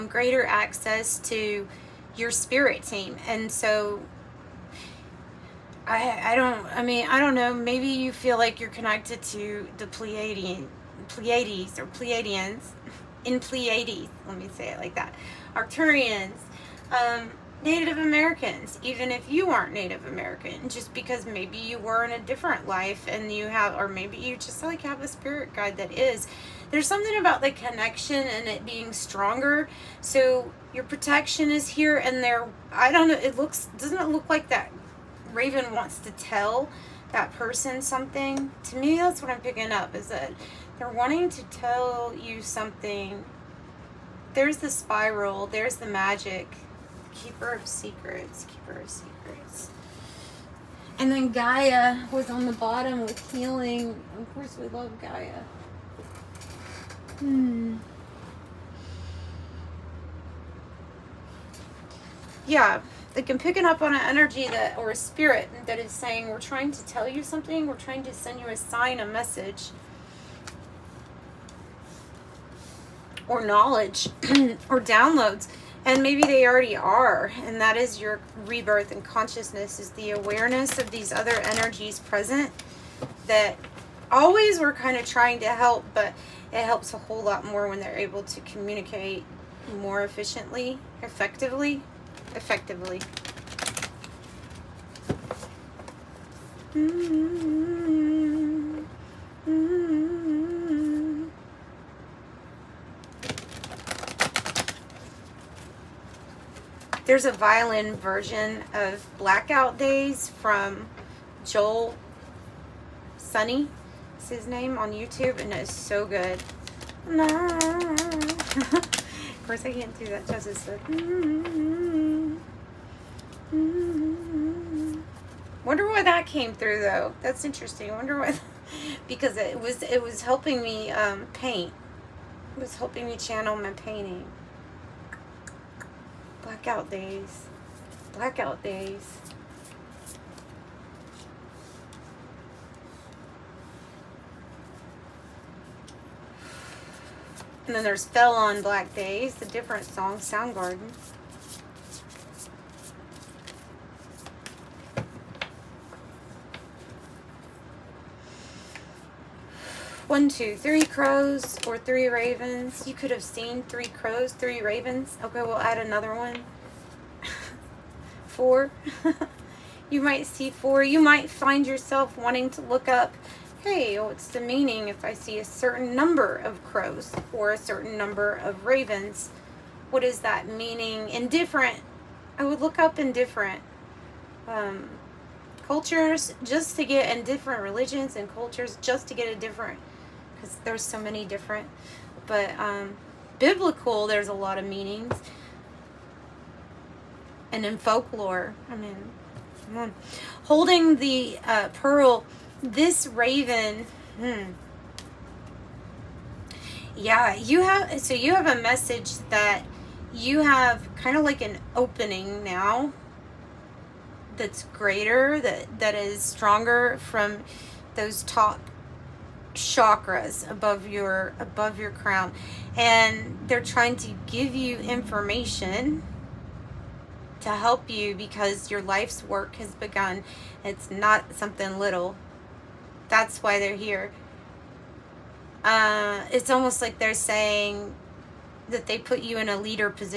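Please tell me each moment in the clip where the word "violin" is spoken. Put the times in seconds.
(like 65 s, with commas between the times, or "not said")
107 s.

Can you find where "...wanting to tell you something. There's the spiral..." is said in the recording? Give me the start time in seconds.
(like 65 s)
40 s.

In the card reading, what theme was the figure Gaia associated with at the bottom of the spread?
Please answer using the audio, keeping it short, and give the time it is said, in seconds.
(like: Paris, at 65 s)
Healing, at 53 s.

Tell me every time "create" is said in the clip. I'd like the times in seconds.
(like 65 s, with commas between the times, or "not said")
not said.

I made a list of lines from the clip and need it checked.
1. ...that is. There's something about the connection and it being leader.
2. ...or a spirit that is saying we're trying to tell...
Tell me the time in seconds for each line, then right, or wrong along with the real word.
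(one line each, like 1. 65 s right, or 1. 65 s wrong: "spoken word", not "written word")
1. 25 s wrong: "stronger", not "leader"
2. 64 s right.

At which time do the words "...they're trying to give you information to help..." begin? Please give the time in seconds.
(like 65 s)
223 s.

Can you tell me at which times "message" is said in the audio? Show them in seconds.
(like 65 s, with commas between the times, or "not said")
69 s, 208 s.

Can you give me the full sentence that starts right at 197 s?
And in folklore, I mean, hmm.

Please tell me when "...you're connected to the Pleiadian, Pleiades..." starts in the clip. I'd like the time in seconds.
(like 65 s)
8 s.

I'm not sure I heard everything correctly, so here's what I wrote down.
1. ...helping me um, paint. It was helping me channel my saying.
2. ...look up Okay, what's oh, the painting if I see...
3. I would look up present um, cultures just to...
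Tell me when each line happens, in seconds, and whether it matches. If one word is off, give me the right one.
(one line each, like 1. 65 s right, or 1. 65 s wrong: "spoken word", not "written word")
1. 130 s wrong: "painting", not "saying"
2. 172 s wrong: "meaning", not "painting"
3. 182 s wrong: "indifferent", not "present".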